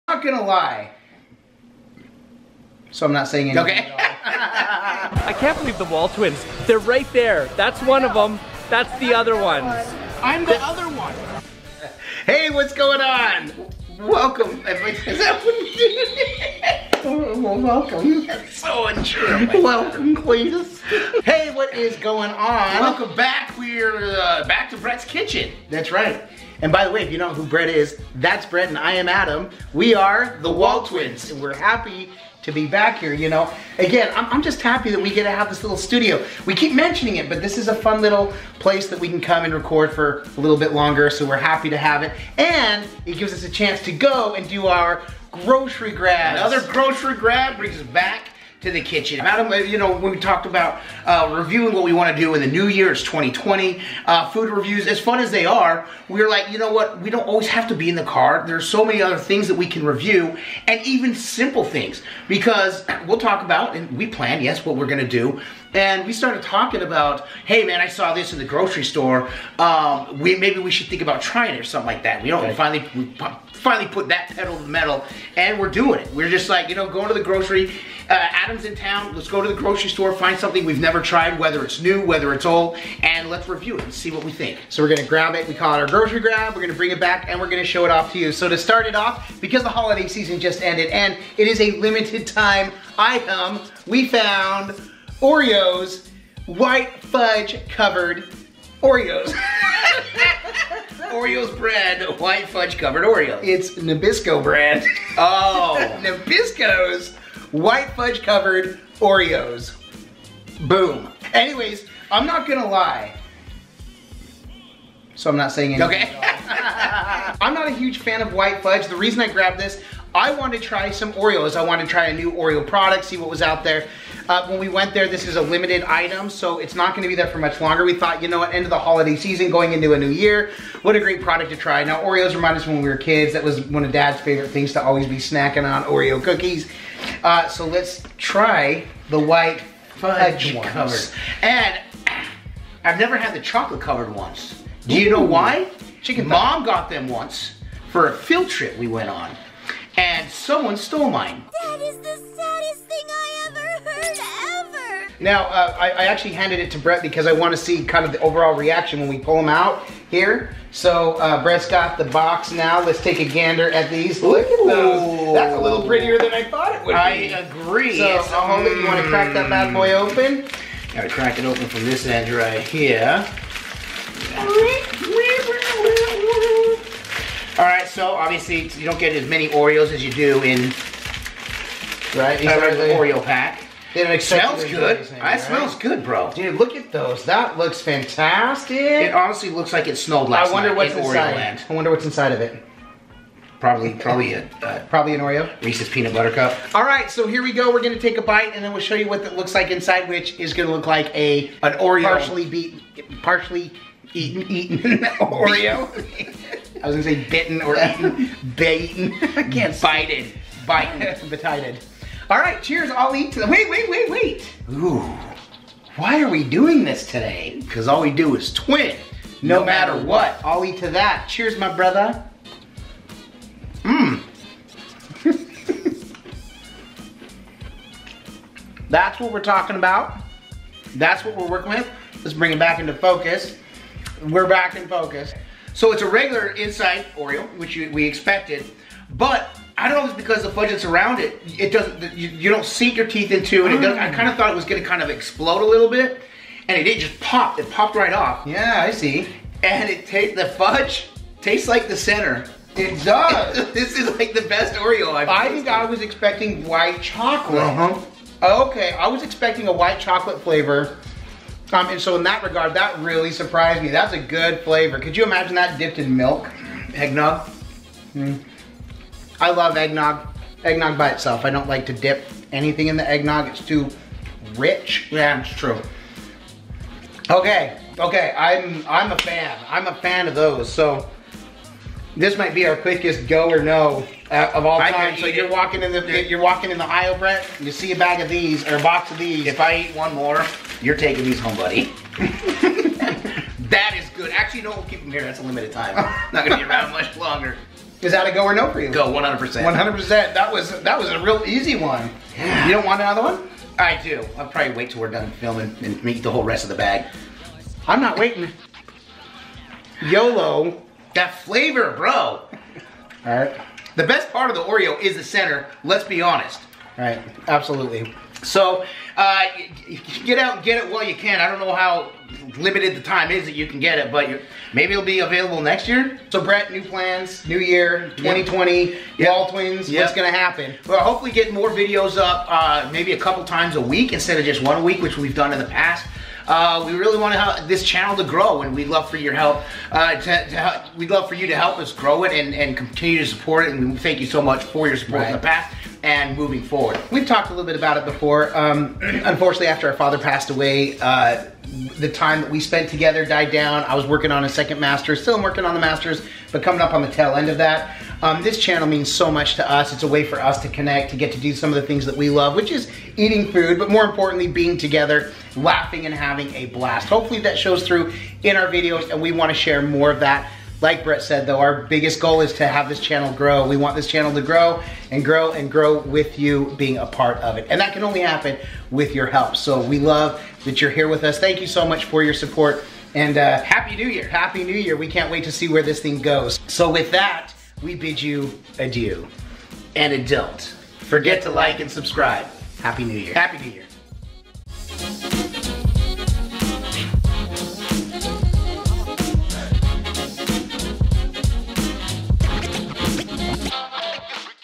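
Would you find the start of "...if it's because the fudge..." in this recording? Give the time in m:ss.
4:00.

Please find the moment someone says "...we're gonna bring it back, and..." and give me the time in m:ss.
1:26.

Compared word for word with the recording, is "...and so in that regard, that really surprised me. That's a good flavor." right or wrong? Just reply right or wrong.
right.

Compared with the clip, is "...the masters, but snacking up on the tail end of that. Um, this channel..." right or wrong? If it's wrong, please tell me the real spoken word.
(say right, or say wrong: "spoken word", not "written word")
wrong: "coming", not "snacking".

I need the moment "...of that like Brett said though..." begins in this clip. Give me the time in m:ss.
6:10.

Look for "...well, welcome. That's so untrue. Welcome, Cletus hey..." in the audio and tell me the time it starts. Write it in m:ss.
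0:17.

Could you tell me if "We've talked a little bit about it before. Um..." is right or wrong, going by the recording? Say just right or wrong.
right.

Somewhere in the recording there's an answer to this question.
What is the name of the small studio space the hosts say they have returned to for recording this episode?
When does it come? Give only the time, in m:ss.
0:24.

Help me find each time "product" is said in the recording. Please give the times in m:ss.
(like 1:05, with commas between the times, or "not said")
2:02, 2:11.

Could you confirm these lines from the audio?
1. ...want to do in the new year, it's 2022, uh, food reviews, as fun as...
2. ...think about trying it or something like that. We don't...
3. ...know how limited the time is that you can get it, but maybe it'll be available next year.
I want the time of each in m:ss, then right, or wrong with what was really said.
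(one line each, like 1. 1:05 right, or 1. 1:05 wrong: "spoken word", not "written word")
1. 0:51 wrong: "2020", not "2022"
2. 1:10 right
3. 5:21 right.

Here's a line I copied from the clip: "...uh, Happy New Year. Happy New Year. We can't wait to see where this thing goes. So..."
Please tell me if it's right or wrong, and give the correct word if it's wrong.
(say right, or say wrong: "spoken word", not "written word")
right.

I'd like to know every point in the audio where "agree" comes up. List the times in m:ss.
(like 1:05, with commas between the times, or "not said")
2:47.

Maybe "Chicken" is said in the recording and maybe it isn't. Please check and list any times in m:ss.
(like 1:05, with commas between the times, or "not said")
2:26.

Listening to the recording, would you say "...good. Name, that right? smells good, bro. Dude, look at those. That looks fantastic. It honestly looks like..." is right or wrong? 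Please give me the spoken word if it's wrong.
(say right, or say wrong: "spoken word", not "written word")
right.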